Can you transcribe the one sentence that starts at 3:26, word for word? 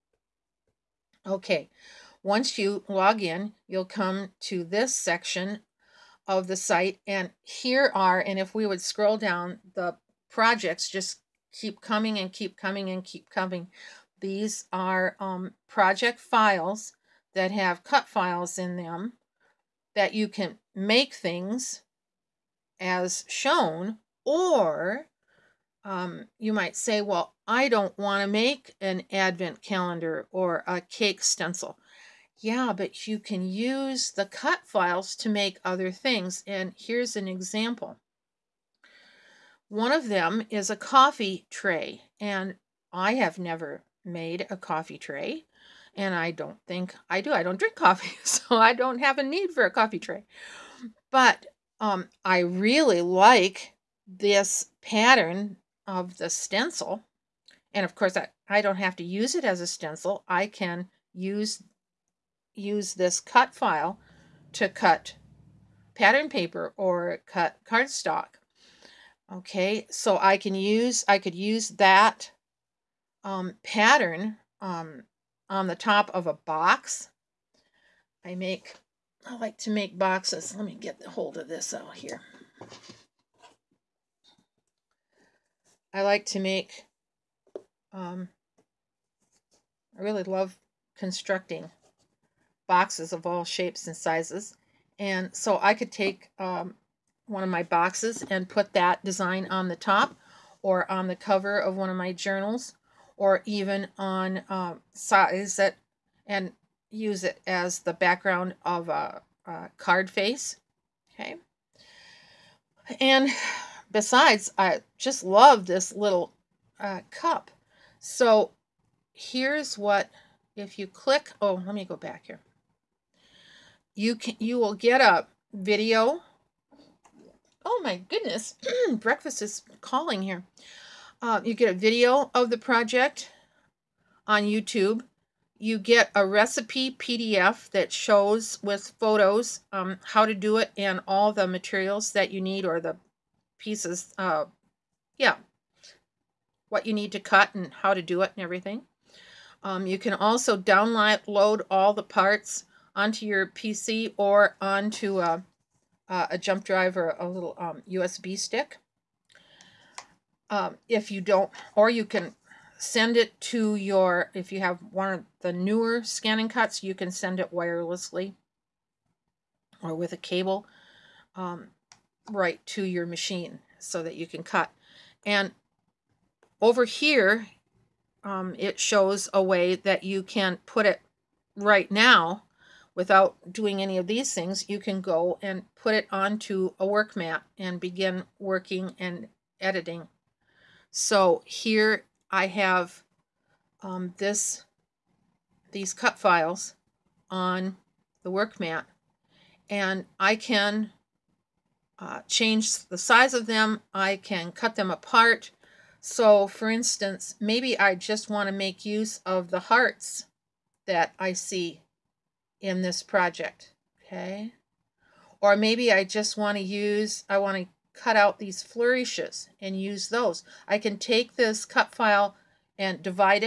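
So for instance, maybe I just want to make use of the hearts that I see in this project.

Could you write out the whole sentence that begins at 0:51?
But um, I really like this pattern of the stencil.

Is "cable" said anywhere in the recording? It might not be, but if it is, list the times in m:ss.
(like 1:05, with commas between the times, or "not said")
2:50.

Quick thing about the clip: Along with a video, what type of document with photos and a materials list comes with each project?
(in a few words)
recipe PDF.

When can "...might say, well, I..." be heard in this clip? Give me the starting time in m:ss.
0:26.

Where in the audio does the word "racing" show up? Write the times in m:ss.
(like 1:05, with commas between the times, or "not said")
not said.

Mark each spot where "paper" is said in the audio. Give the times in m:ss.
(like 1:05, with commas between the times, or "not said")
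1:06.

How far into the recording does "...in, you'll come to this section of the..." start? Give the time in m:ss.
0:03.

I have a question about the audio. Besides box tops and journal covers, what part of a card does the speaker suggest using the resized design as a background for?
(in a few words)
card face.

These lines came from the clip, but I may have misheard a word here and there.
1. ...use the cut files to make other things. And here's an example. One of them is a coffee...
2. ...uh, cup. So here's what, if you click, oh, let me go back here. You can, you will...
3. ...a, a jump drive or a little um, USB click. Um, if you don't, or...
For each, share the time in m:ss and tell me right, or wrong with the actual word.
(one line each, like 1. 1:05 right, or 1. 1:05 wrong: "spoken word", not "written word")
1. 0:33 right
2. 1:56 right
3. 2:35 wrong: "stick", not "click".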